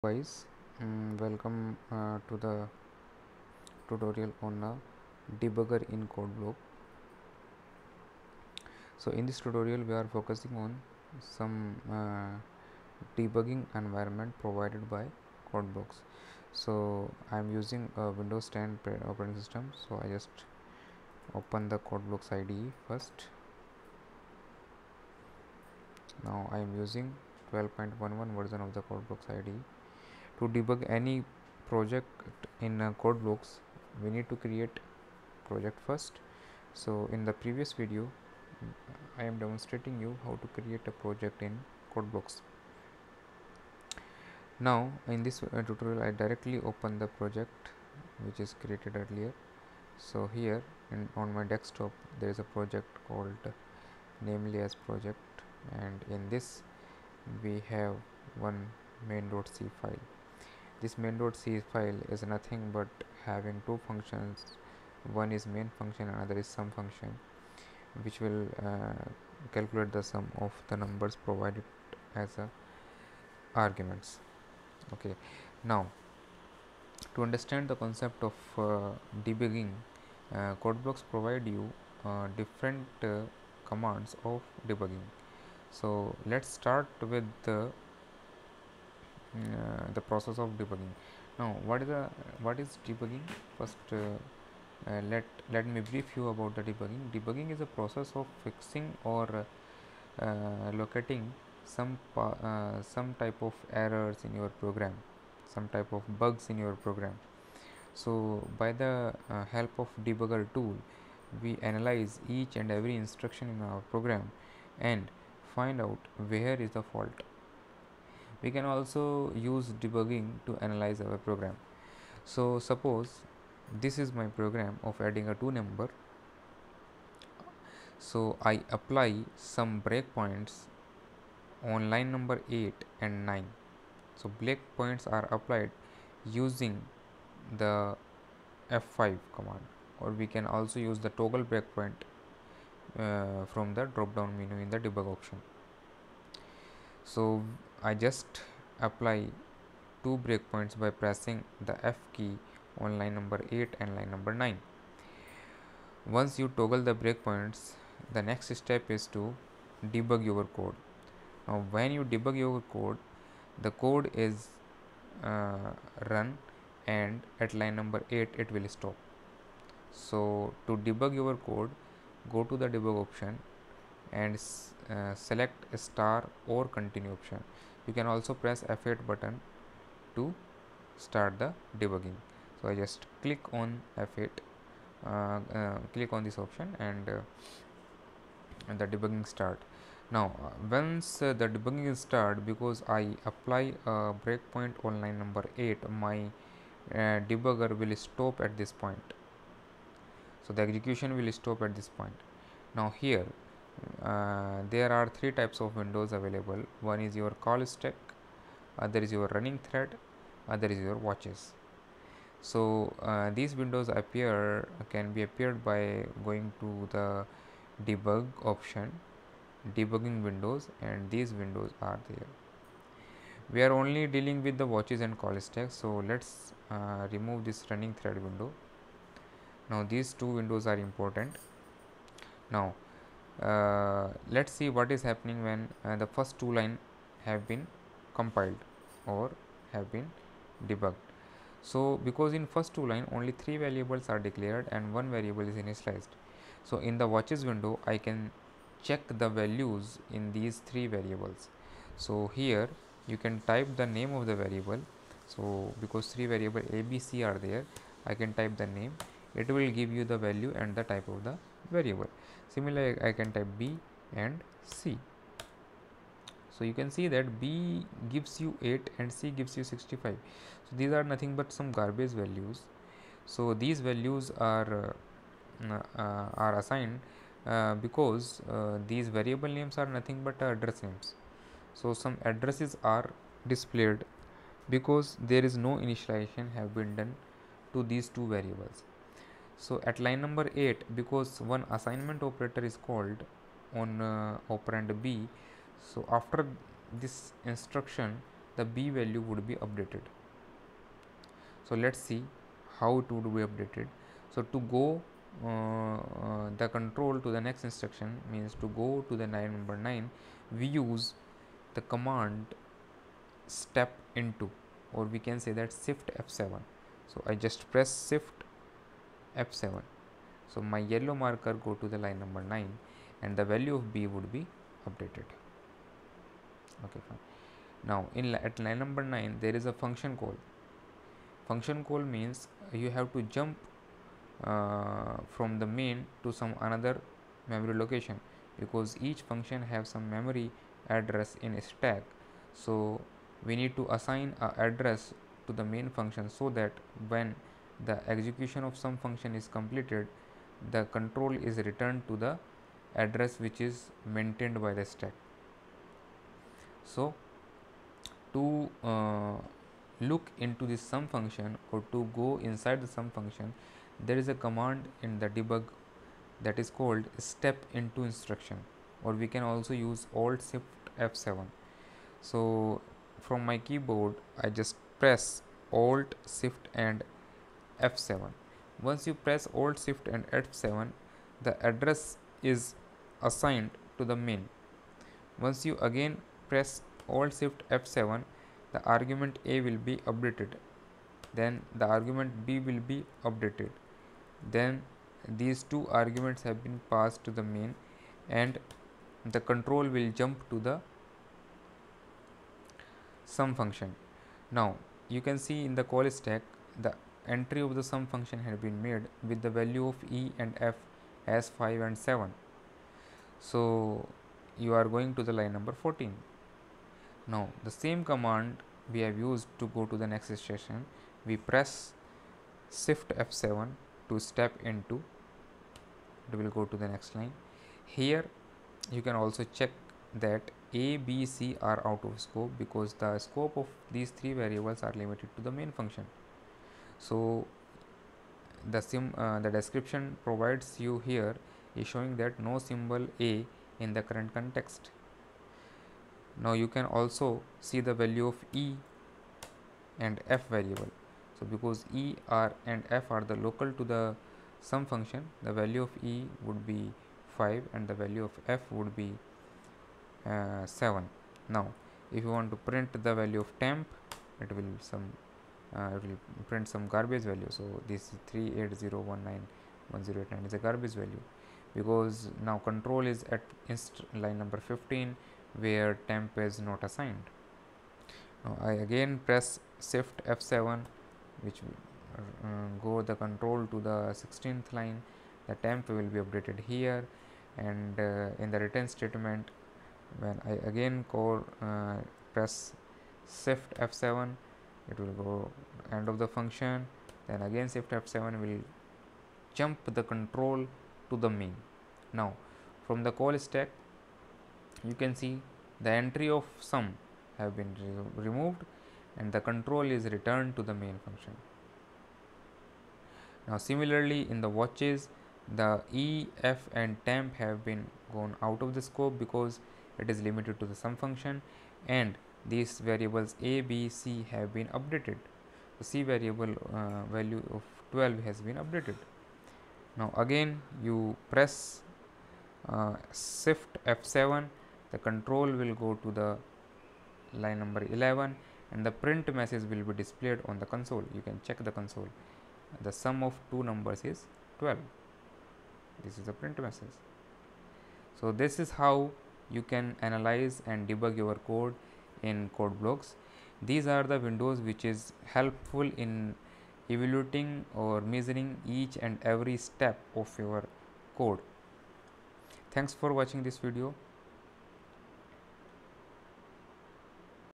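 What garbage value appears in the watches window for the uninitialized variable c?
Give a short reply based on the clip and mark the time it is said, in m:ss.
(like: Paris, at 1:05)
65, at 4:29.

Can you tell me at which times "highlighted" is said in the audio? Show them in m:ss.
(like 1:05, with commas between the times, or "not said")
not said.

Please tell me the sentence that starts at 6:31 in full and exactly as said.
Then the argument B will be updated.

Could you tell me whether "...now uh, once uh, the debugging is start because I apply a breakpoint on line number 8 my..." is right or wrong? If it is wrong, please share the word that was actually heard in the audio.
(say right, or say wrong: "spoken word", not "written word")
right.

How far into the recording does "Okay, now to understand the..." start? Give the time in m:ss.
1:14.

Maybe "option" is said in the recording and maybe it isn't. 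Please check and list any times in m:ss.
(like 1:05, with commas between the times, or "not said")
2:25, 2:53, 2:57, 3:06, 3:38.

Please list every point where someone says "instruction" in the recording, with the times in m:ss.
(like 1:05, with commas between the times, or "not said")
1:52, 4:57, 5:07, 6:08.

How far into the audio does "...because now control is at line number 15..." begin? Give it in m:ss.
7:51.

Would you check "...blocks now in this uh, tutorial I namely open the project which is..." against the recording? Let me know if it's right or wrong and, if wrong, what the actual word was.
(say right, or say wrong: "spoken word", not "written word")
wrong: "directly", not "namely".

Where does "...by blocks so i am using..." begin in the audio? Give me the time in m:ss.
0:14.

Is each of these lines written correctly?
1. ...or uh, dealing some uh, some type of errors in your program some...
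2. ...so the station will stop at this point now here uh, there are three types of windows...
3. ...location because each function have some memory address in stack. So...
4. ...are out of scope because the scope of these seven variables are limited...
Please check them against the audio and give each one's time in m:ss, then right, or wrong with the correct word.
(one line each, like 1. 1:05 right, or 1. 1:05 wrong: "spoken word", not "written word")
1. 1:39 wrong: "locating", not "dealing"
2. 3:20 wrong: "execution", not "station"
3. 5:37 right
4. 7:11 wrong: "three", not "seven".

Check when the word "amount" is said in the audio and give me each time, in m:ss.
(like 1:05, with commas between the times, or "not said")
not said.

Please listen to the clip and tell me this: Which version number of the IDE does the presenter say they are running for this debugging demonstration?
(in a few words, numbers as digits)
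12.11.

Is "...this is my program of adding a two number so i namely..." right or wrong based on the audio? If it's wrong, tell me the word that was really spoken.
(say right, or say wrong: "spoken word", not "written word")
wrong: "apply", not "namely".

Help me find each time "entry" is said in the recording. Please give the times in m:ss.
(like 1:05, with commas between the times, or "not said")
6:47, 8:26.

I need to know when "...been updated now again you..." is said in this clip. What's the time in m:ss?
8:48.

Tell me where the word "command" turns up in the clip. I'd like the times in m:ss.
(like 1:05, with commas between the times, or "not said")
1:23, 2:19, 5:11, 6:04, 6:58.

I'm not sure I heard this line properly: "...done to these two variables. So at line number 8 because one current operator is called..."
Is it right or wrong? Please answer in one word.
wrong.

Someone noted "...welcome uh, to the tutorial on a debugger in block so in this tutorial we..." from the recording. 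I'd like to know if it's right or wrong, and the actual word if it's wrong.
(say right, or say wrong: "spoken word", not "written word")
right.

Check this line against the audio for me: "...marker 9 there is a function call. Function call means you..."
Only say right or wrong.
wrong.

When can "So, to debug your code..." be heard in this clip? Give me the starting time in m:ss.
2:49.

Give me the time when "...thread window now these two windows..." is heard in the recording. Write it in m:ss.
3:47.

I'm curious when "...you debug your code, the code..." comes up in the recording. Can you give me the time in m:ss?
2:41.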